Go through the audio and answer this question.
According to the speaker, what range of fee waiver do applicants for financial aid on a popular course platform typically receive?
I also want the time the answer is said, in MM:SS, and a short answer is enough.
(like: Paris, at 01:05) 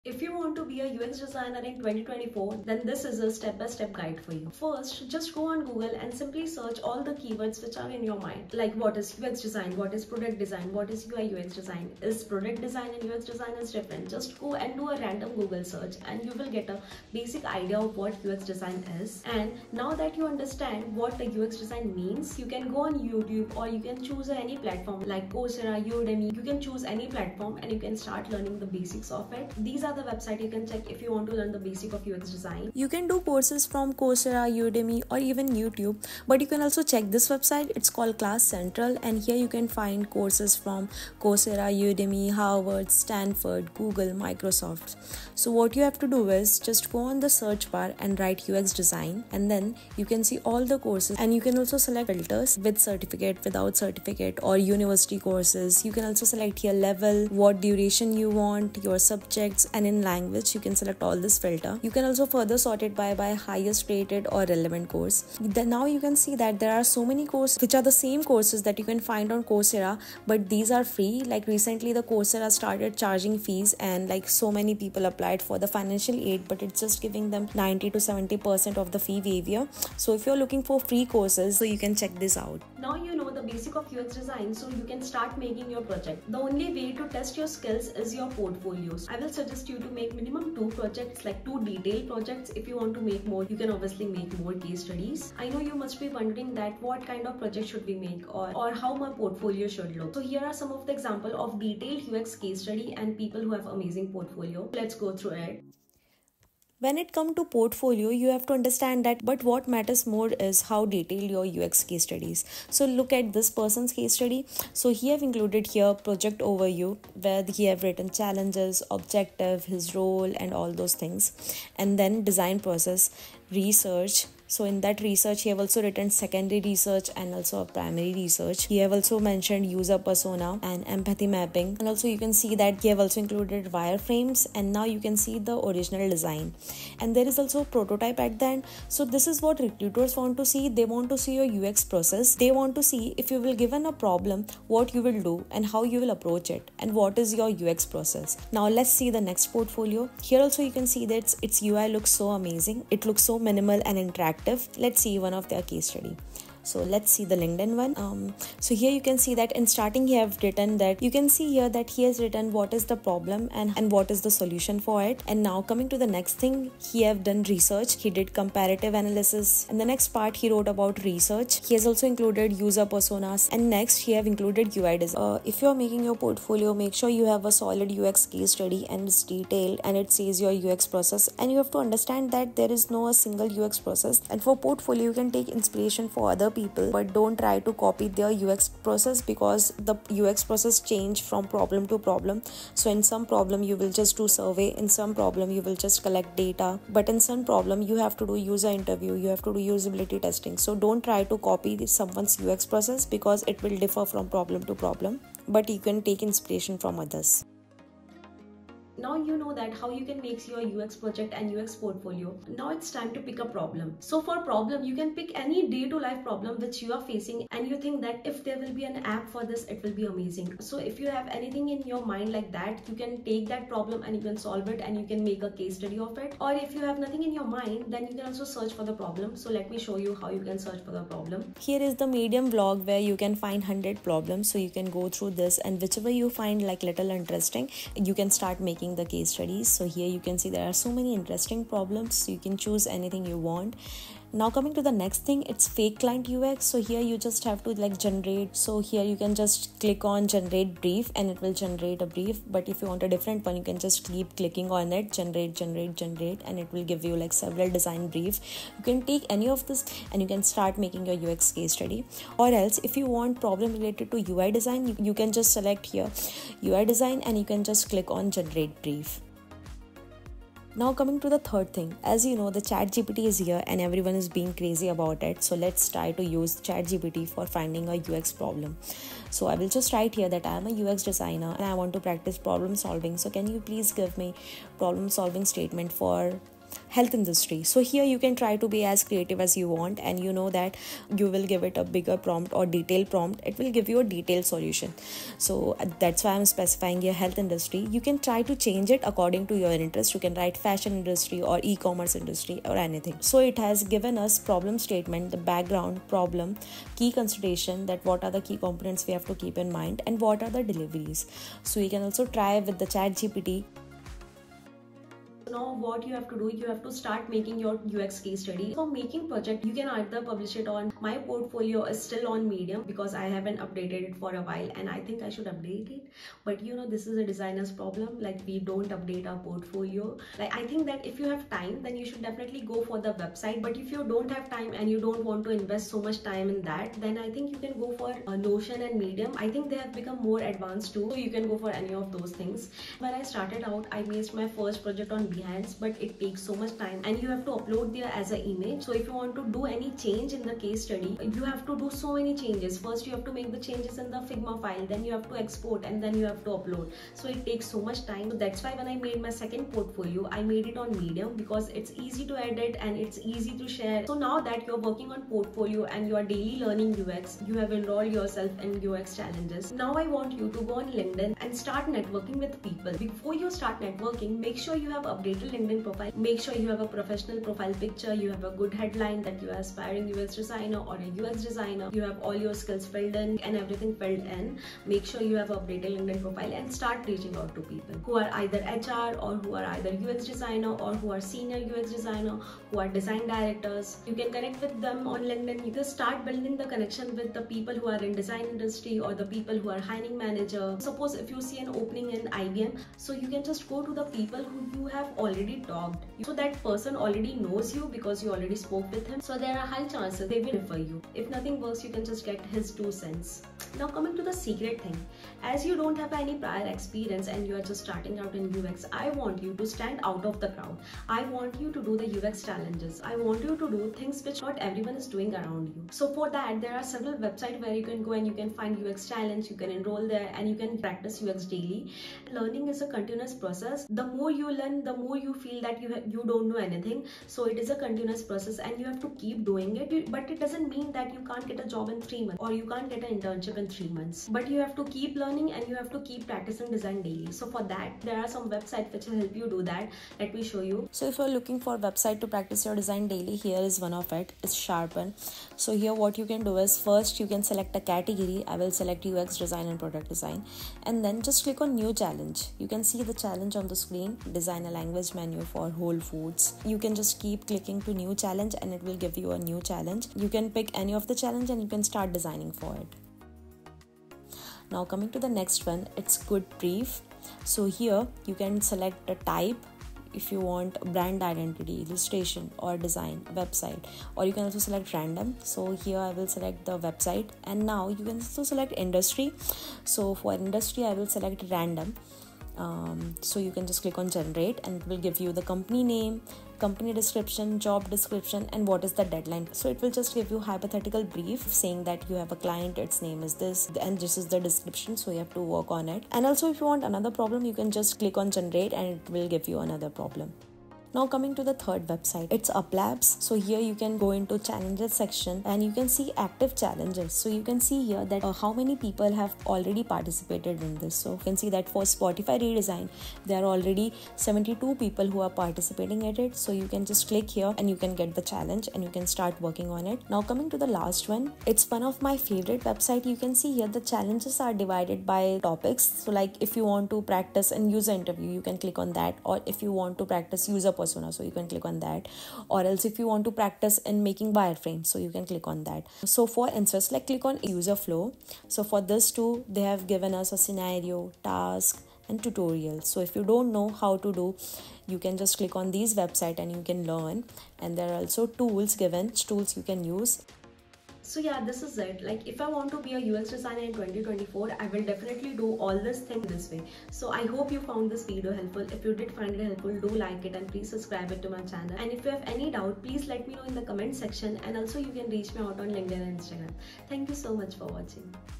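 90 to 70%, at 01:17.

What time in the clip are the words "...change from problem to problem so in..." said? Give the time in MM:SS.
03:10.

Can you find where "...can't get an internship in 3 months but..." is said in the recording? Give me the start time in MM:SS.
07:22.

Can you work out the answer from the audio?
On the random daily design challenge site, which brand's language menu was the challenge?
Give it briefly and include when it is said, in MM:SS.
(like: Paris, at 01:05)
Whole Foods, at 07:45.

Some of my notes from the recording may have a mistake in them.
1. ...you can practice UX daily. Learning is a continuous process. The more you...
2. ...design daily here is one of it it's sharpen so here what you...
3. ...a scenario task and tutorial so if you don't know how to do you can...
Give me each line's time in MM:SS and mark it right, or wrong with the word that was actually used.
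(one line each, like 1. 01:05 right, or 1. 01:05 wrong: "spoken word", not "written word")
1. 07:10 right
2. 07:32 right
3. 09:10 right.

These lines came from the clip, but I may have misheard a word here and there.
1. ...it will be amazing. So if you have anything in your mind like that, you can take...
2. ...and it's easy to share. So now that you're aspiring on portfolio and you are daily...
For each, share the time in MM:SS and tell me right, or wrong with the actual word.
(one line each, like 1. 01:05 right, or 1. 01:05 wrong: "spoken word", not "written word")
1. 03:39 right
2. 06:02 wrong: "working", not "aspiring".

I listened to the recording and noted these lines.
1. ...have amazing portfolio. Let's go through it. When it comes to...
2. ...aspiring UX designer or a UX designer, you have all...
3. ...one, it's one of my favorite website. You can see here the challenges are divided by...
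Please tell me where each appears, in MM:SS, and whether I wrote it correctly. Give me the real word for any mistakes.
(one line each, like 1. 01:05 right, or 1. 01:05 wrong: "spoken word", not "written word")
1. 01:43 right
2. 06:19 right
3. 08:51 right.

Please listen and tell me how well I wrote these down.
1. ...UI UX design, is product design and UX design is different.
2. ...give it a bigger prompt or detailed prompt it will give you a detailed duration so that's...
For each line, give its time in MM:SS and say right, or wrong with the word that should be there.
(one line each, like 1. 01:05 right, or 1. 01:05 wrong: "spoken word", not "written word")
1. 00:11 right
2. 04:51 wrong: "solution", not "duration".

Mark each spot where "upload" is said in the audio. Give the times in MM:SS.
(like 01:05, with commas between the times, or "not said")
05:47, 05:56.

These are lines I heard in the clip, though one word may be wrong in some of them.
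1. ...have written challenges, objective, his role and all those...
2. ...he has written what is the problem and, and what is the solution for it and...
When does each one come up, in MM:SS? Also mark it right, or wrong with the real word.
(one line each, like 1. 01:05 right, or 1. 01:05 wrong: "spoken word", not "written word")
1. 01:57 right
2. 02:41 right.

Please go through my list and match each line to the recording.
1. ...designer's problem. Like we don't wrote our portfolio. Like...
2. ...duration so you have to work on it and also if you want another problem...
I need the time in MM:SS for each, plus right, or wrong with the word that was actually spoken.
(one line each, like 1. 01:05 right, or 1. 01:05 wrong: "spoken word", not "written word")
1. 05:27 wrong: "update", not "wrote"
2. 08:24 wrong: "description", not "duration".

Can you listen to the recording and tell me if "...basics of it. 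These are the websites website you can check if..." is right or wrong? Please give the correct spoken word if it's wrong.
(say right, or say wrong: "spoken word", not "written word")
right.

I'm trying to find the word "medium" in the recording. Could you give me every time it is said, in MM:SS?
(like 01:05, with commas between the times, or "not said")
03:52, 05:22, 05:38, 06:00.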